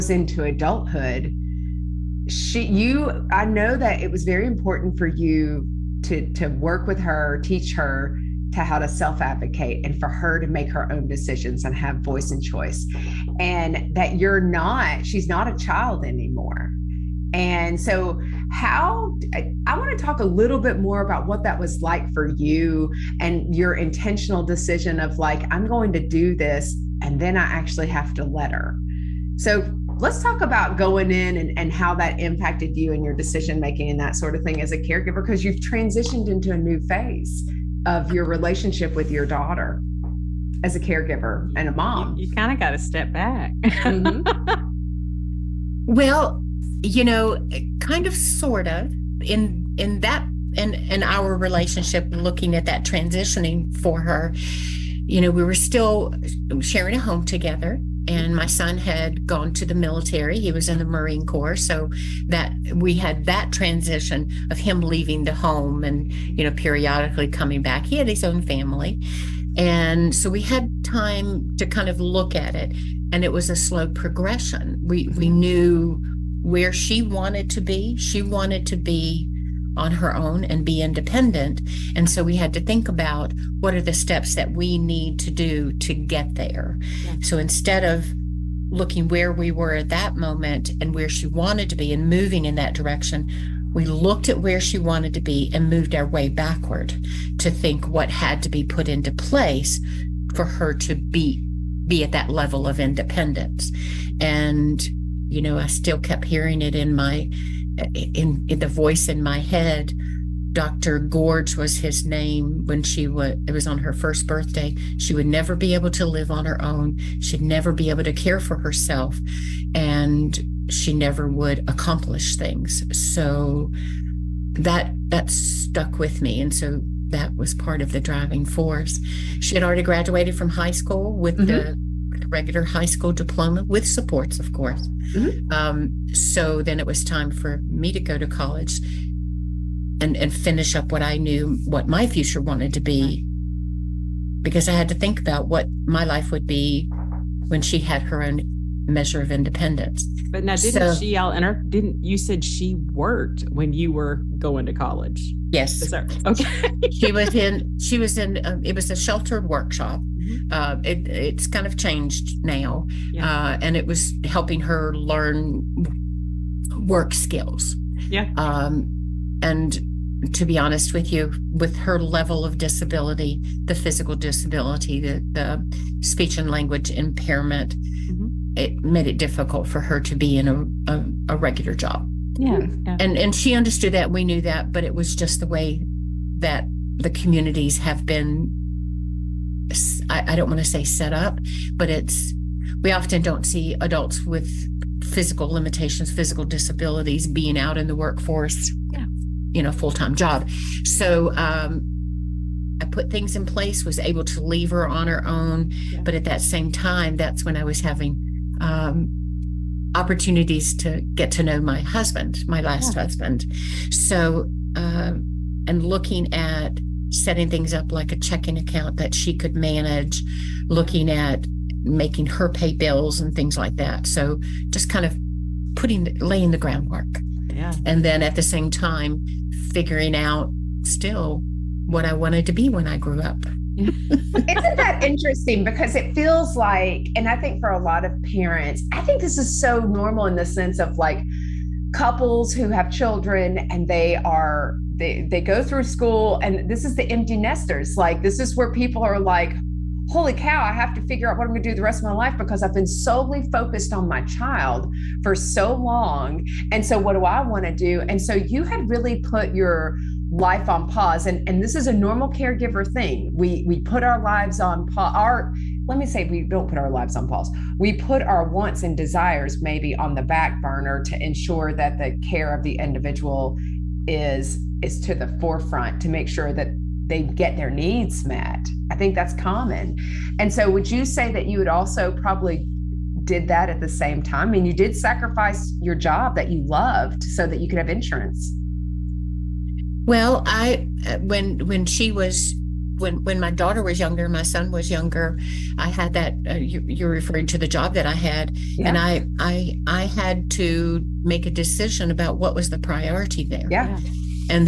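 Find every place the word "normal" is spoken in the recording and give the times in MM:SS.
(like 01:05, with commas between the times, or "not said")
03:59, 04:21.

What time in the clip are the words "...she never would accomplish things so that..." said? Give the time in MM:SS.
02:00.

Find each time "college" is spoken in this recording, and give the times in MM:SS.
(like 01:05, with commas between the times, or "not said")
02:18, 02:34.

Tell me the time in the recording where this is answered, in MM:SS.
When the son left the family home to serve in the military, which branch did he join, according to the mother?
01:00.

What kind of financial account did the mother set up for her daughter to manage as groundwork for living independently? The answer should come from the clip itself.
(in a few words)
Checking account.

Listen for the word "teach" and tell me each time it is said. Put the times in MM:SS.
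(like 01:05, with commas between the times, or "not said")
00:07.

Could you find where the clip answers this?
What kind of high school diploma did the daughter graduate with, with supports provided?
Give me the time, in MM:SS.
02:12.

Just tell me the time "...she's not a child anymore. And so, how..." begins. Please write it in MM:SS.
00:15.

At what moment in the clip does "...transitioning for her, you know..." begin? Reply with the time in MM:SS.
00:52.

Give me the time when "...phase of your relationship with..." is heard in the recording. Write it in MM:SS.
00:36.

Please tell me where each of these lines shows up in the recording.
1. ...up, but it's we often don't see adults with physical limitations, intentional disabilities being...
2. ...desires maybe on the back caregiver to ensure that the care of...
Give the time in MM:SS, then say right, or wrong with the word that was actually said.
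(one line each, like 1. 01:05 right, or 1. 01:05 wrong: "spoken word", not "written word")
1. 03:11 wrong: "physical", not "intentional"
2. 04:28 wrong: "burner", not "caregiver".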